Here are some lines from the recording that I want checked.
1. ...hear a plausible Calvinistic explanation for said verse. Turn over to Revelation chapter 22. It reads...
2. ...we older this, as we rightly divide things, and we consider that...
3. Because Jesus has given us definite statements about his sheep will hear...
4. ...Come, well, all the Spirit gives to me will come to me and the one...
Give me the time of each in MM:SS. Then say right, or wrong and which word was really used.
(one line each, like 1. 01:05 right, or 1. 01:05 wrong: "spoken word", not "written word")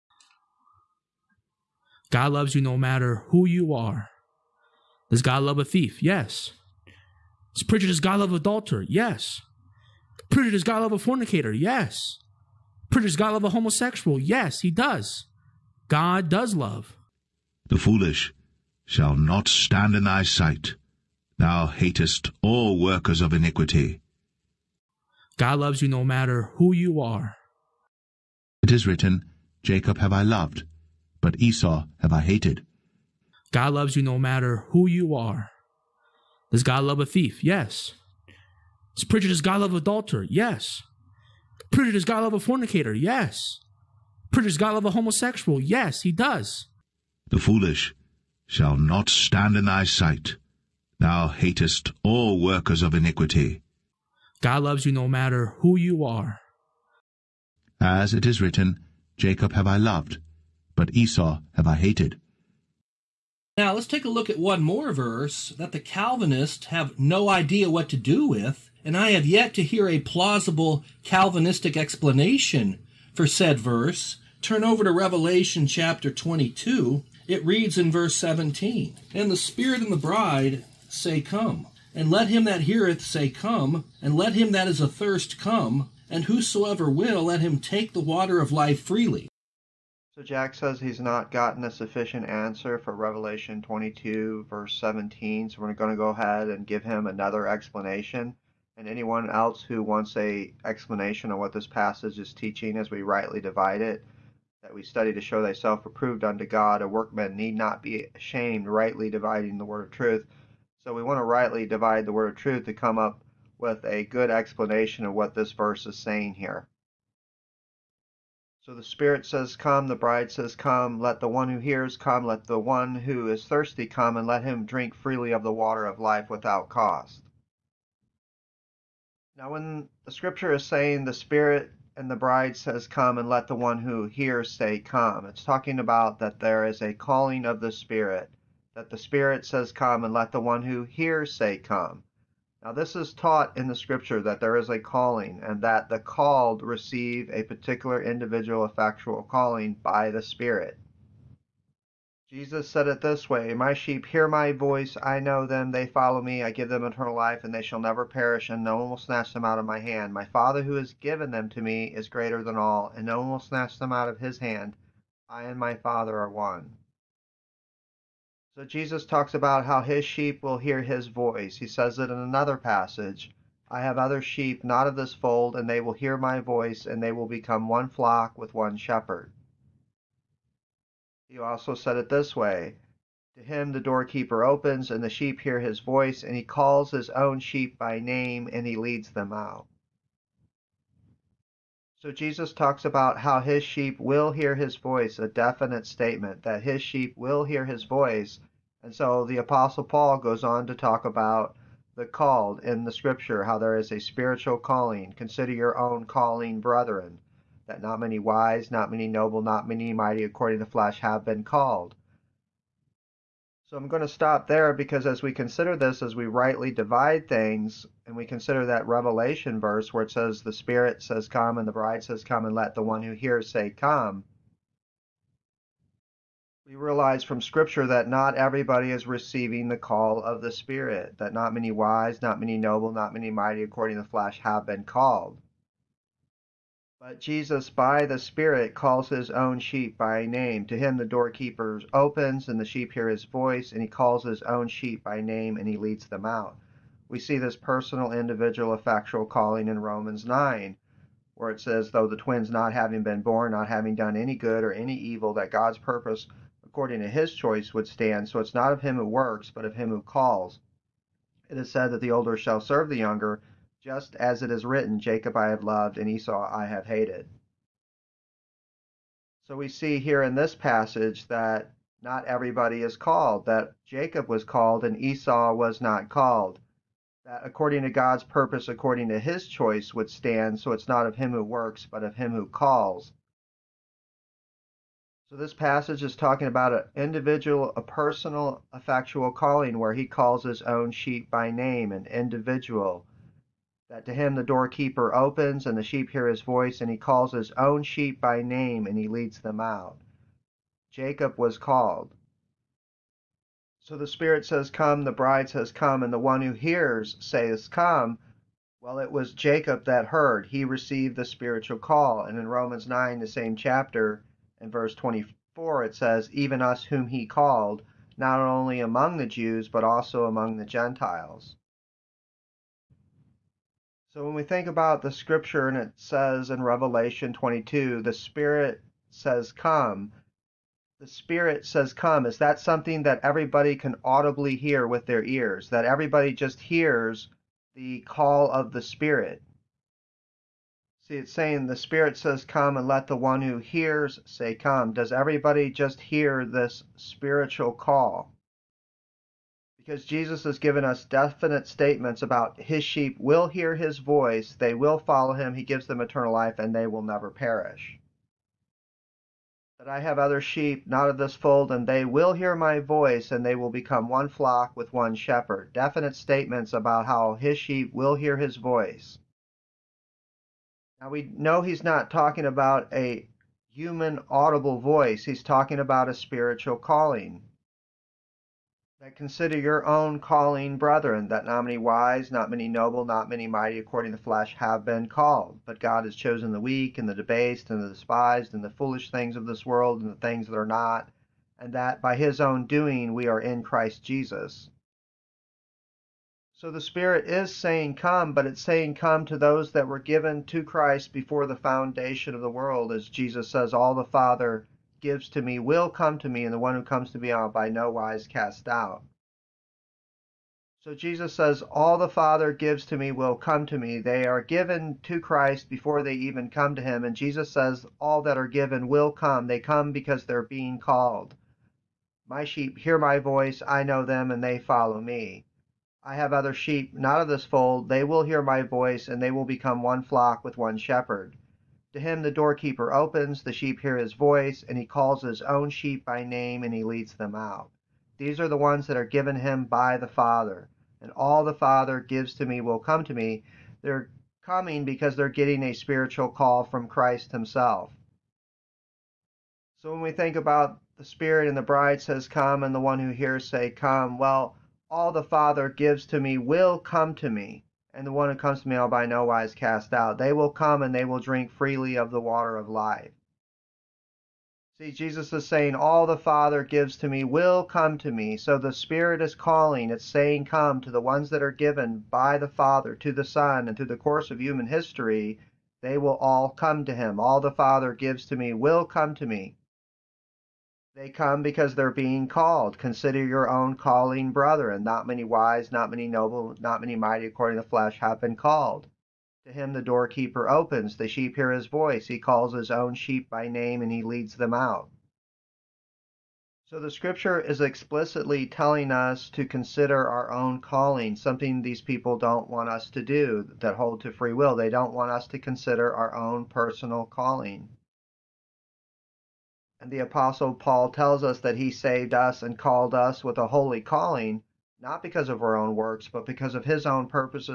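1. 01:09 right
2. 03:35 wrong: "consider", not "older"
3. 05:49 right
4. 07:33 wrong: "Father", not "Spirit".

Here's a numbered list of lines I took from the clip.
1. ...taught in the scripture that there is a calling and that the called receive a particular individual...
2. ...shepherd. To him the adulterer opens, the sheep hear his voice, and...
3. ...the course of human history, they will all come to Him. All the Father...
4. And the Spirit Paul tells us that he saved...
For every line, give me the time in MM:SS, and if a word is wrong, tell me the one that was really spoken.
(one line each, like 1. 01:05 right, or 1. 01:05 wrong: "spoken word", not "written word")
1. 02:23 right
2. 07:10 wrong: "doorkeeper", not "adulterer"
3. 07:53 right
4. 08:29 wrong: "Apostle", not "Spirit".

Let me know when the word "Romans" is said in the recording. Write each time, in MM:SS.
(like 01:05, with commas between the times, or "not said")
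04:09, 05:12.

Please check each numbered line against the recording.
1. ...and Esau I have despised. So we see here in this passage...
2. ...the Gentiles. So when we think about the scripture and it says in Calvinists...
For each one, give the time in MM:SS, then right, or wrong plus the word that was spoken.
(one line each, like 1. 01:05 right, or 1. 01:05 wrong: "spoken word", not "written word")
1. 04:25 wrong: "hated", not "despised"
2. 05:20 wrong: "Revelation", not "Calvinists".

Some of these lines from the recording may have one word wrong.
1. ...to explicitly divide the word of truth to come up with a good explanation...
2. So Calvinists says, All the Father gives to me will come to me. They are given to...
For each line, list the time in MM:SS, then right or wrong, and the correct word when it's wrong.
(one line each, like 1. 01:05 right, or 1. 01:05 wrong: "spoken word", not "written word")
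1. 01:51 wrong: "rightly", not "explicitly"
2. 06:50 wrong: "Jesus", not "Calvinists".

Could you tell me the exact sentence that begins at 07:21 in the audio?
And all the Father gives to me will come to me.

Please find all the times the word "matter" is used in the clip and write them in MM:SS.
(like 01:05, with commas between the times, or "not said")
00:02, 00:26, 00:34, 00:55.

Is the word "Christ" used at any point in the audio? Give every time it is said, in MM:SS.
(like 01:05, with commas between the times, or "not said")
06:33, 06:40, 06:55, 07:26.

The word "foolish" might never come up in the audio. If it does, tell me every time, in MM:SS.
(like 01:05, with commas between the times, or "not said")
00:17, 00:47, 06:28.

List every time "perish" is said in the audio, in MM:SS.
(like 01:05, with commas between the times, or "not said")
02:38, 05:57.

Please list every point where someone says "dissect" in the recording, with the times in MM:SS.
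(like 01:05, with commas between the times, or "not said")
not said.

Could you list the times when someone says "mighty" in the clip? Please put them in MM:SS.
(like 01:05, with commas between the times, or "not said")
03:29, 03:53, 06:23, 08:06.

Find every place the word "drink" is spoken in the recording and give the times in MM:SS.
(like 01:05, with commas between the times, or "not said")
02:04, 07:41.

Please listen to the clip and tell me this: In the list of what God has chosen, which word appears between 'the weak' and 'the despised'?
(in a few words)
debased.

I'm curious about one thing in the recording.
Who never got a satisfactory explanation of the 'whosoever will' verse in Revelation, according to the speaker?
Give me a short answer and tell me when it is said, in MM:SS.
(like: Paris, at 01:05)
Jack, at 01:30.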